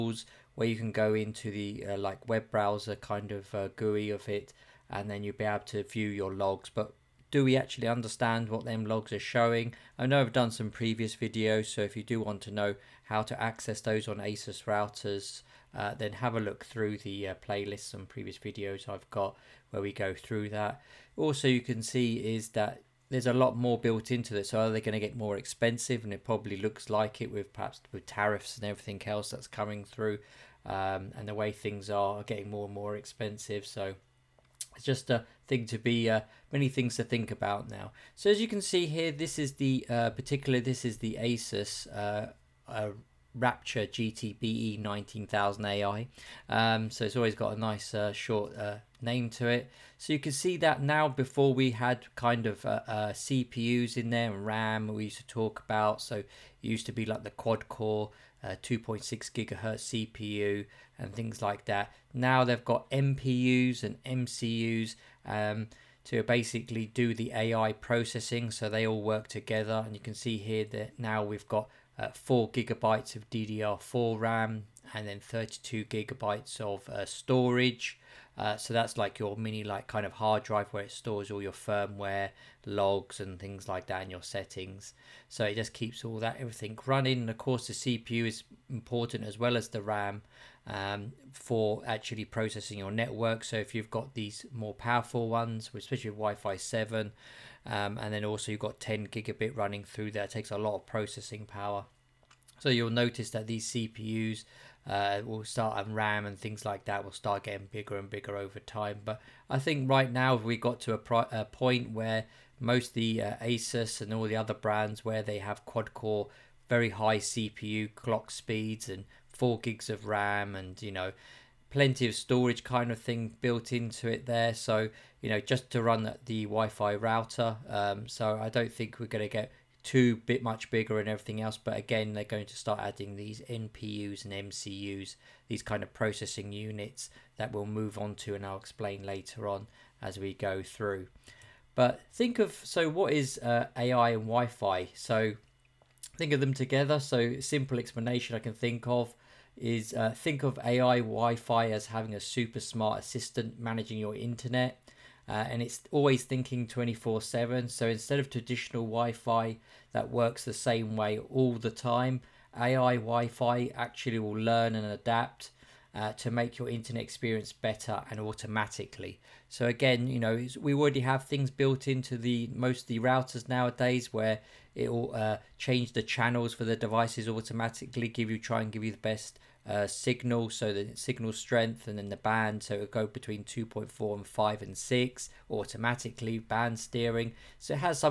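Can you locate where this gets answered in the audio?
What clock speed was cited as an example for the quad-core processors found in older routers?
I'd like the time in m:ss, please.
0:58.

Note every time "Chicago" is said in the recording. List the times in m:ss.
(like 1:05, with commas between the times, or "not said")
not said.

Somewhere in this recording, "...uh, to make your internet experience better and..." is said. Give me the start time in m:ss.
2:45.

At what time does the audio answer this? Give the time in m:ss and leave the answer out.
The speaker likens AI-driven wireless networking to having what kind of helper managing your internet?
2:32.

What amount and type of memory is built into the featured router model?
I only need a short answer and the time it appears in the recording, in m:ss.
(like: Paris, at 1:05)
4 gigabytes of DDR4, at 1:12.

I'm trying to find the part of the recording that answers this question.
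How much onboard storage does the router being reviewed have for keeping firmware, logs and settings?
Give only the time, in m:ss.
1:15.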